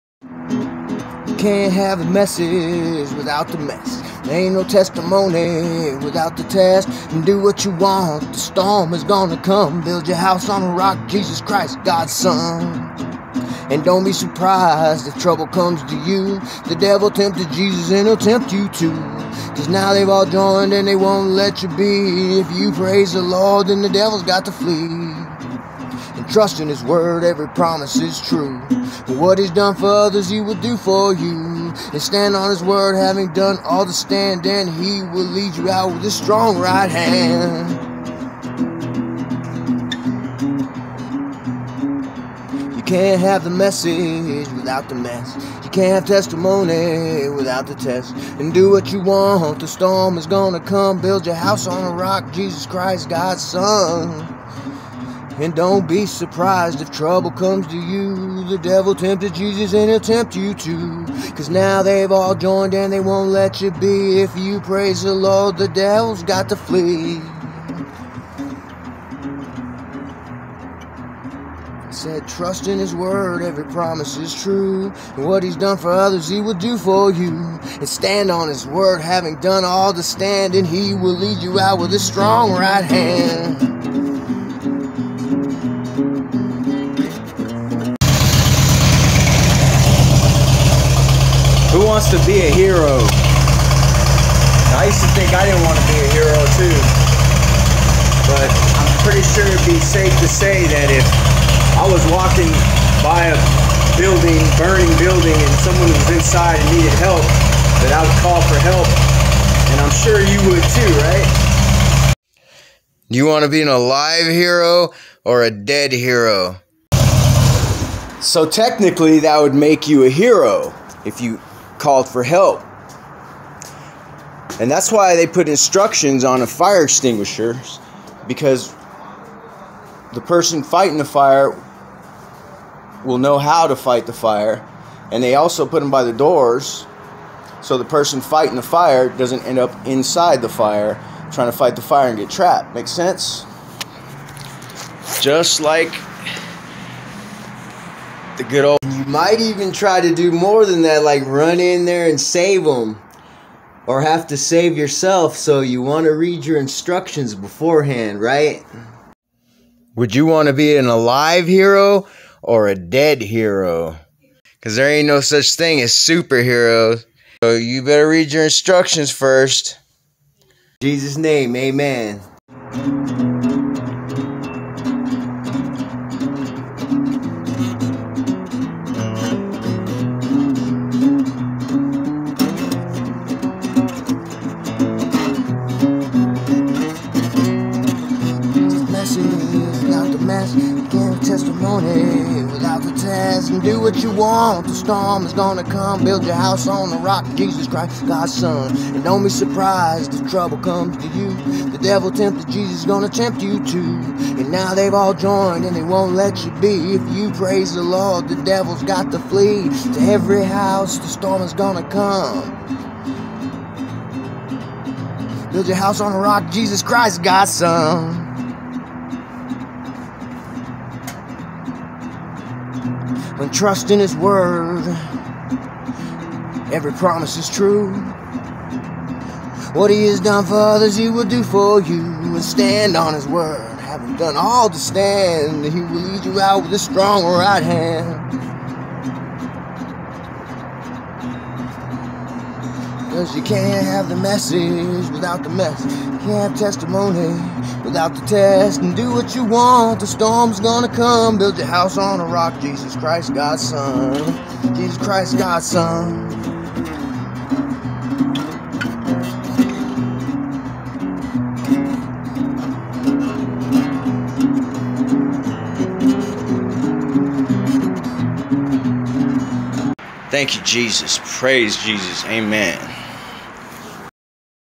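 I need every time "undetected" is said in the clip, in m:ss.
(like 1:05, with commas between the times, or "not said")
not said.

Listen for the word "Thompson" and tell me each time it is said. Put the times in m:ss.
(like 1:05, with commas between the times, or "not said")
not said.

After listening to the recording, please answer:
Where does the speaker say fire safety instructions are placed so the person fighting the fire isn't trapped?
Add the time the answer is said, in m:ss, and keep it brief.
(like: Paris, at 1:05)
by the doors, at 2:15.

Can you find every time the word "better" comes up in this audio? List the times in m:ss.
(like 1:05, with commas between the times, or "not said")
2:47.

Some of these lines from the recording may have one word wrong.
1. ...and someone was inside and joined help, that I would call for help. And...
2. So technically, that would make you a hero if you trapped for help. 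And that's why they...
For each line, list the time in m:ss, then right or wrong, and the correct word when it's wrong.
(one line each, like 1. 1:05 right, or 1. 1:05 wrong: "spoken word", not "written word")
1. 1:45 wrong: "needed", not "joined"
2. 1:58 wrong: "called", not "trapped".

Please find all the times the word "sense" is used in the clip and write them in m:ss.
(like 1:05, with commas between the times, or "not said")
2:22.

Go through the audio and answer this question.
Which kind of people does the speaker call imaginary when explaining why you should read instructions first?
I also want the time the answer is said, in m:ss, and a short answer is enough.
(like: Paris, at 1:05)
superheroes, at 2:45.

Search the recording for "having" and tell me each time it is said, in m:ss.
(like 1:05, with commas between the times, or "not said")
0:32, 1:19, 3:53.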